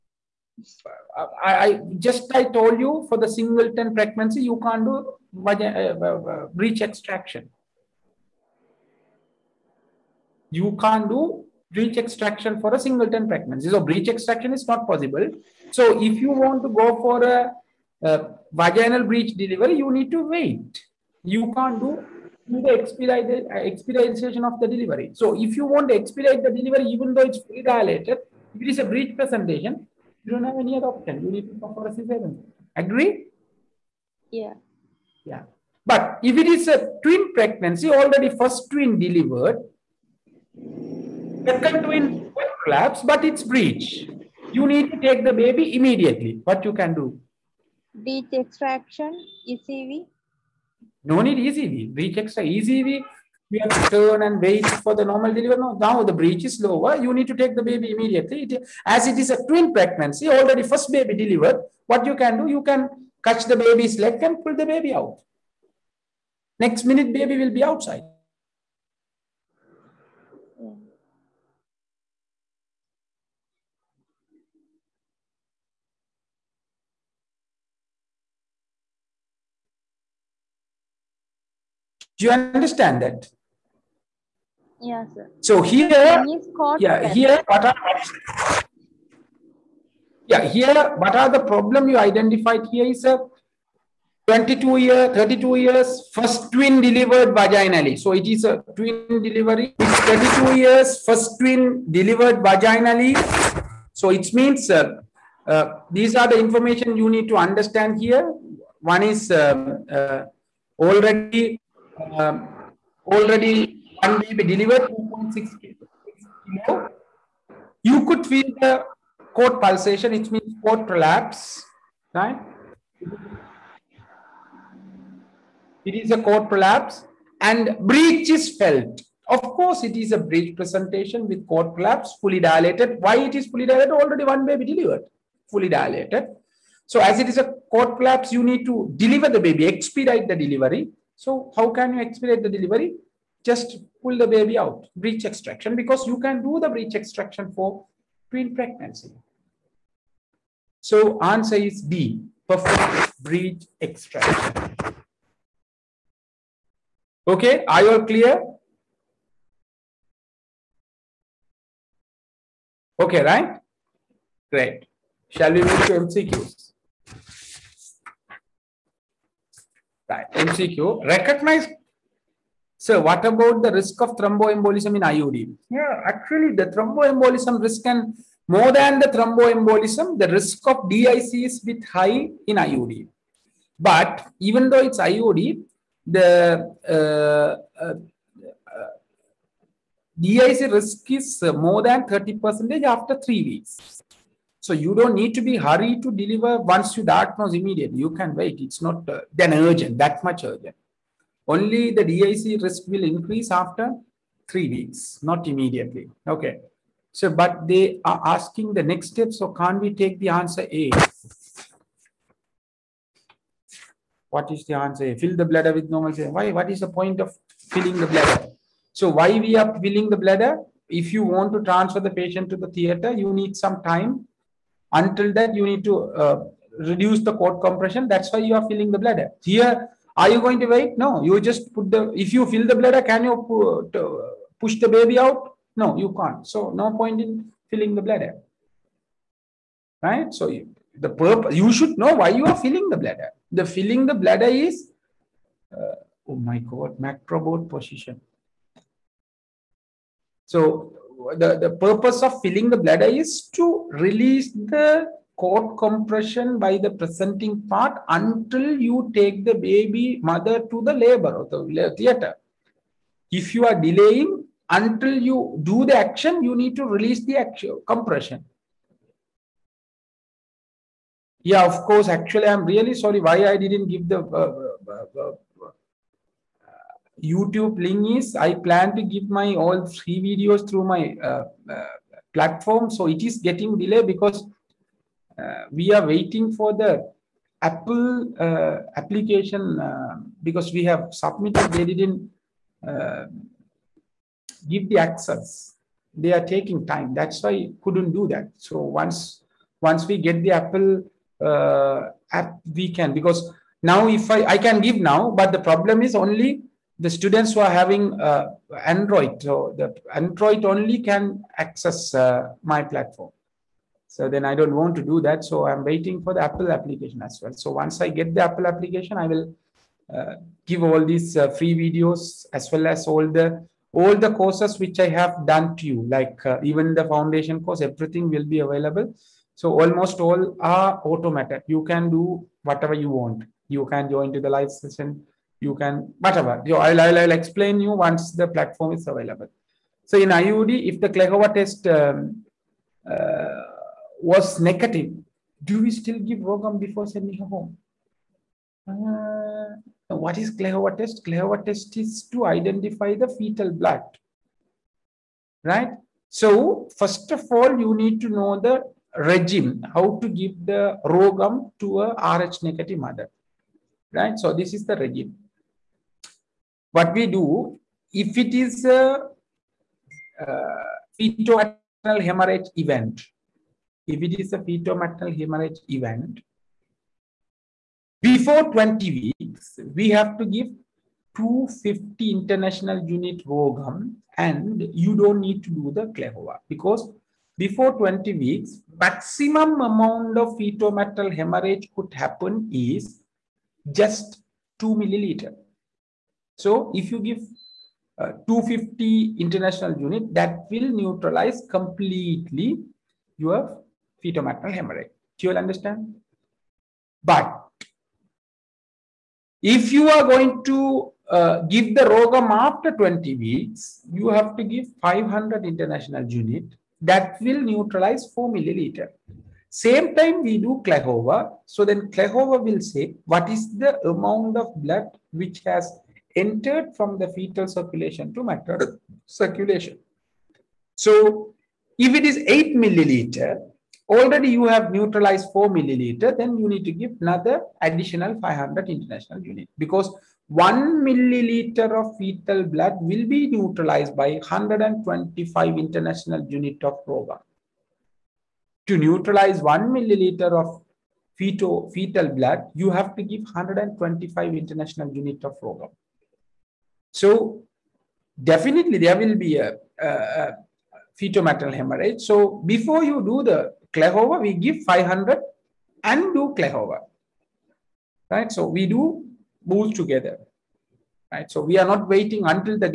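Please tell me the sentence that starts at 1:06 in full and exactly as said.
Next minute, baby will be outside.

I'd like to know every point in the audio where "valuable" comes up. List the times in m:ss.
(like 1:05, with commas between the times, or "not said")
not said.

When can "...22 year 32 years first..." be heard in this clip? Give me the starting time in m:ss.
1:34.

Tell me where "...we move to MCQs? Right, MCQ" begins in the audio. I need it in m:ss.
2:45.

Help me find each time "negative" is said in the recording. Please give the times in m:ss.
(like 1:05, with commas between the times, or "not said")
5:44, 6:02.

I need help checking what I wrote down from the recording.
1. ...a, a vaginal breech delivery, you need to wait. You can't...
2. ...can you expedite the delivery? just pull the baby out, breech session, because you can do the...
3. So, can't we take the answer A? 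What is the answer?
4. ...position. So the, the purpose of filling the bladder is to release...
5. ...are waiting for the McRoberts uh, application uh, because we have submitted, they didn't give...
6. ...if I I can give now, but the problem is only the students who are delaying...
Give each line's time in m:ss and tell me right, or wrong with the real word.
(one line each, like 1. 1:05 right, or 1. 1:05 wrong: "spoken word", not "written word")
1. 0:17 right
2. 2:21 wrong: "extraction", not "session"
3. 3:29 right
4. 4:07 right
5. 4:45 wrong: "Apple", not "McRoberts"
6. 5:04 wrong: "having", not "delaying".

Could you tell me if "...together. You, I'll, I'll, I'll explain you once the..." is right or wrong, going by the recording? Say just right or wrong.
wrong.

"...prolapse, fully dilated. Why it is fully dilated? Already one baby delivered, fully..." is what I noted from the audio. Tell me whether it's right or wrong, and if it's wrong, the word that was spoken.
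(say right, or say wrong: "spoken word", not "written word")
right.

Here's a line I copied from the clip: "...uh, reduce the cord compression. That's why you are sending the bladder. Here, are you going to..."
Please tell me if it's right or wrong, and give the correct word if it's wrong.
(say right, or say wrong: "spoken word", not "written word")
wrong: "filling", not "sending".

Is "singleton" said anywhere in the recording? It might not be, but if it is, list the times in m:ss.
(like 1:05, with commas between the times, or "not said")
0:03, 0:12.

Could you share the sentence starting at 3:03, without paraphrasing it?
But even though it's IUD, the uh, uh, uh DIC risk is more than 30% after three weeks.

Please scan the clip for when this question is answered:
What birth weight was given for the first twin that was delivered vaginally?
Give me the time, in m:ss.
1:54.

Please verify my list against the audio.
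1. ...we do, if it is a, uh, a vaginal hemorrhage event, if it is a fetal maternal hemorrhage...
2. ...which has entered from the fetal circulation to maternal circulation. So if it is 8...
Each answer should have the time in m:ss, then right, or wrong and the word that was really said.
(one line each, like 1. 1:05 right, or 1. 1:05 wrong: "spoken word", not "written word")
1. 6:07 wrong: "fetal", not "vaginal"
2. 7:05 right.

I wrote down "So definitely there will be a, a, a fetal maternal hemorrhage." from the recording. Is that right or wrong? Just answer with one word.
right.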